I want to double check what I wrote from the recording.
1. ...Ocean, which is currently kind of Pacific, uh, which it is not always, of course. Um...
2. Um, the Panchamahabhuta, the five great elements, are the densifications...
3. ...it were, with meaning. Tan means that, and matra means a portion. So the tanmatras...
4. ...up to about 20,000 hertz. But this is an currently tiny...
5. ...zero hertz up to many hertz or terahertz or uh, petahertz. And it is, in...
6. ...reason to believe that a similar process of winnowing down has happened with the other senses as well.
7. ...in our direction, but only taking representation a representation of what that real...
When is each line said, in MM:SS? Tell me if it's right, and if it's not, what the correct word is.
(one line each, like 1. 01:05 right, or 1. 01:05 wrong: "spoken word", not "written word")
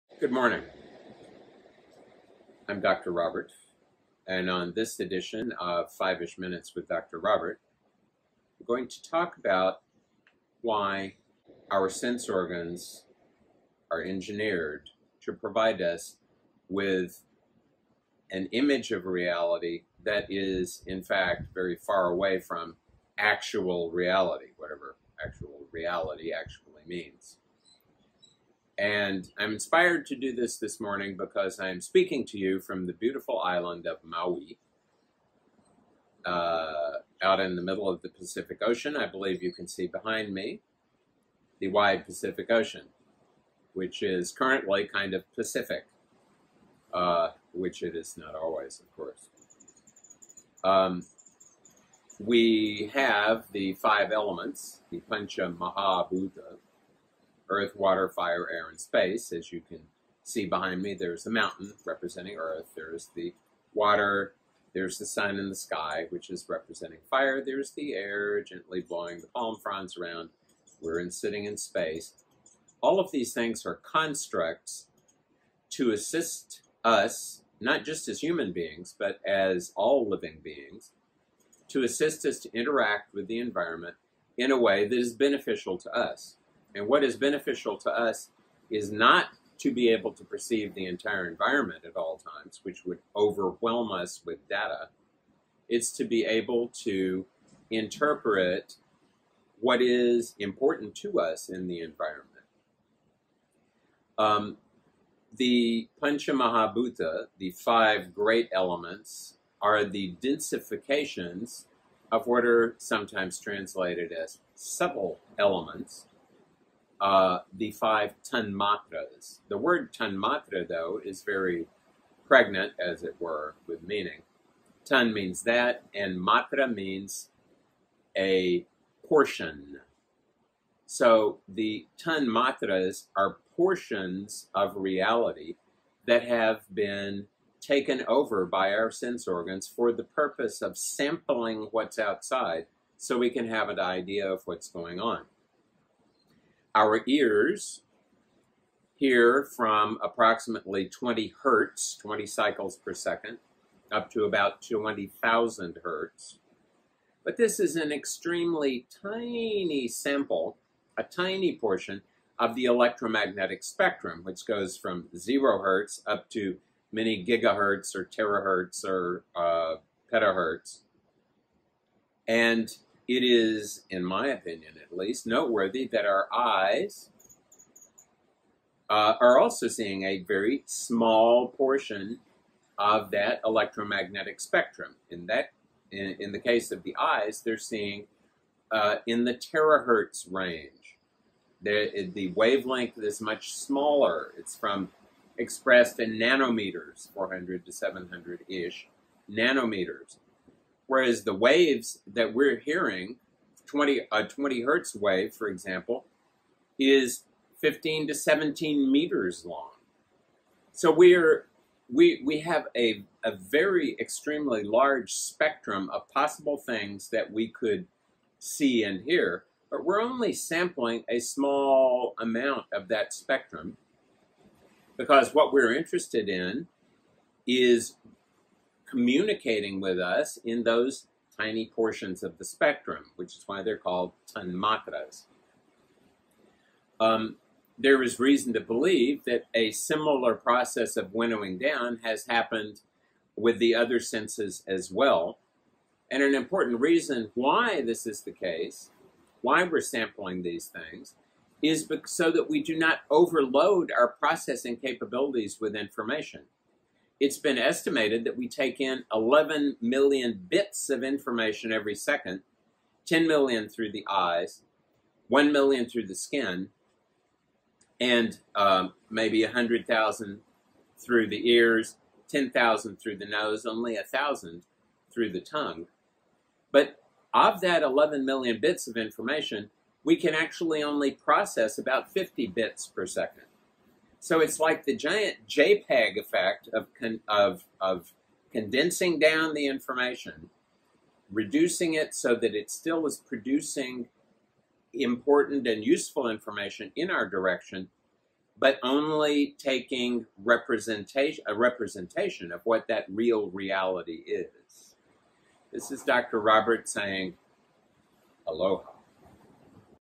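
1. 00:42 right
2. 01:44 right
3. 02:03 right
4. 02:33 wrong: "extremely", not "currently"
5. 02:45 wrong: "gigahertz", not "hertz"
6. 03:58 right
7. 04:56 right.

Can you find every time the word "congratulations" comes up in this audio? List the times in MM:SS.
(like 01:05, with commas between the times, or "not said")
not said.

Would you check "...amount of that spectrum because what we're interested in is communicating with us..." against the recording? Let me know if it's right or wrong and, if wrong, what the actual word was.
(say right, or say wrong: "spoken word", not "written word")
right.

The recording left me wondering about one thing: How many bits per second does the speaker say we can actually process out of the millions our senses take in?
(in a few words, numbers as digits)
50.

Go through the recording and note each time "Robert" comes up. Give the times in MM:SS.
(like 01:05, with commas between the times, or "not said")
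00:03, 00:07, 05:06.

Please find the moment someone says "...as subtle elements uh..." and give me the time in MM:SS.
01:54.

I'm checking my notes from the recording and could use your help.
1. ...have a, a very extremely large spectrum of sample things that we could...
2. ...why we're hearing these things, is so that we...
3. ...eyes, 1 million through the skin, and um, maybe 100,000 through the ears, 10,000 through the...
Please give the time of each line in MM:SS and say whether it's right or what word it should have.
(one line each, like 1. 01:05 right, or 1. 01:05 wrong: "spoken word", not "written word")
1. 03:32 wrong: "possible", not "sample"
2. 04:09 wrong: "sampling", not "hearing"
3. 04:24 right.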